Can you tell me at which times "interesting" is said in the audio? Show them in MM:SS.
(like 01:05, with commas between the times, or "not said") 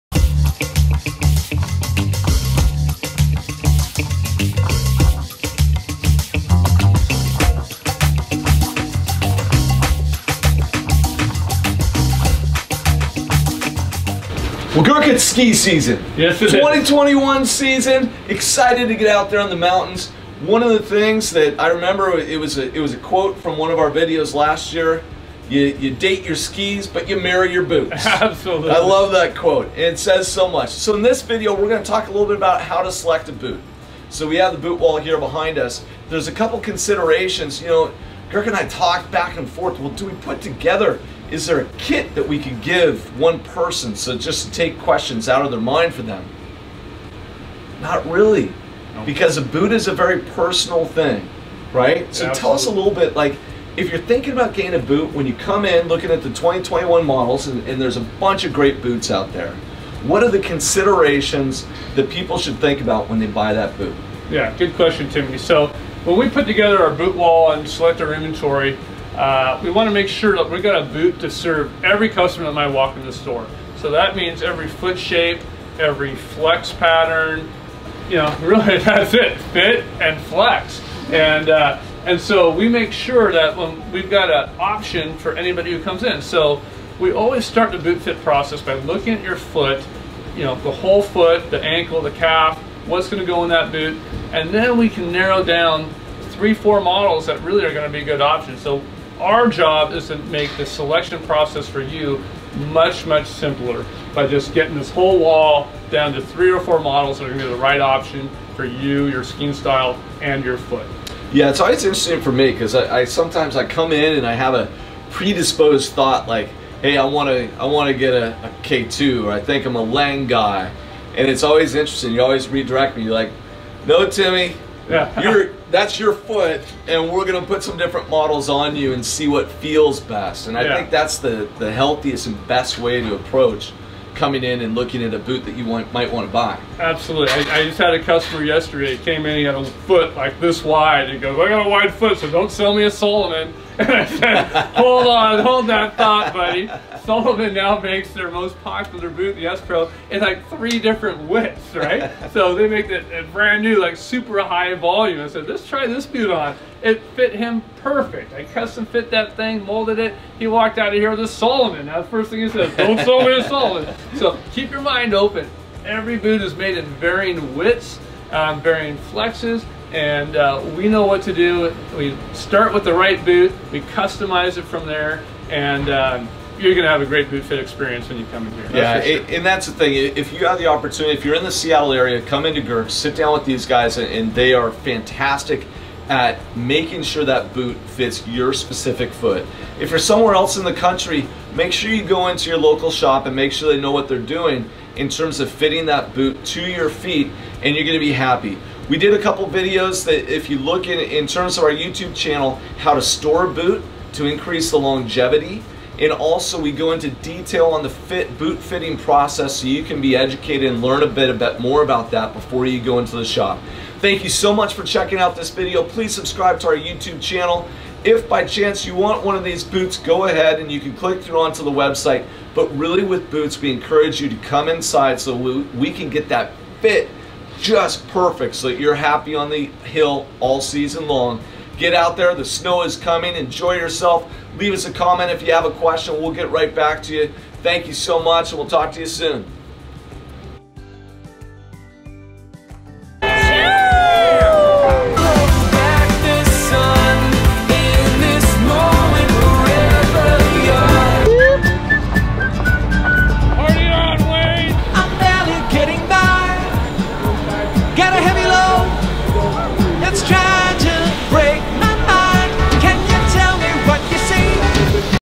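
01:51, 02:01.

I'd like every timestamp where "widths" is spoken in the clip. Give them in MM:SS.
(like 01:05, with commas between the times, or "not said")
02:31, 02:47.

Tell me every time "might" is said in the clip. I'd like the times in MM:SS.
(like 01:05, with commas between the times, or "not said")
01:12, 02:15.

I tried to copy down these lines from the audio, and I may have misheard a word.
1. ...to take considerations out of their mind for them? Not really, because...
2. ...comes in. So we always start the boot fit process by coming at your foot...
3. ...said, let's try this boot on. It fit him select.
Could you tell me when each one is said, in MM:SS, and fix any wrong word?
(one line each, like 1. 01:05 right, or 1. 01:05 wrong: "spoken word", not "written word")
1. 00:44 wrong: "questions", not "considerations"
2. 01:25 wrong: "looking", not "coming"
3. 02:35 wrong: "perfect", not "select".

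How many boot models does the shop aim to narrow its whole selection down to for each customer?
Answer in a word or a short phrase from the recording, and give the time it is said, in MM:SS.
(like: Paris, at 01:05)
3 or 4, at 01:46.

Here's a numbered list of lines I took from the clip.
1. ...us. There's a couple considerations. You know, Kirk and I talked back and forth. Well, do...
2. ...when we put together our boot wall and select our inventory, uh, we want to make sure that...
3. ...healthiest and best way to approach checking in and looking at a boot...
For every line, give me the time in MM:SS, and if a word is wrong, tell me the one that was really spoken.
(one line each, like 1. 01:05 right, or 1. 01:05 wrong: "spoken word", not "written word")
1. 00:35 right
2. 01:06 right
3. 02:11 wrong: "coming", not "checking".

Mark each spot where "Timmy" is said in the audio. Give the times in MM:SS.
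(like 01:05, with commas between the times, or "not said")
01:05, 02:04.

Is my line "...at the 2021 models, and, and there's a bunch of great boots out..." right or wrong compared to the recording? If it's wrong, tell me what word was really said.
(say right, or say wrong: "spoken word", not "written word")
right.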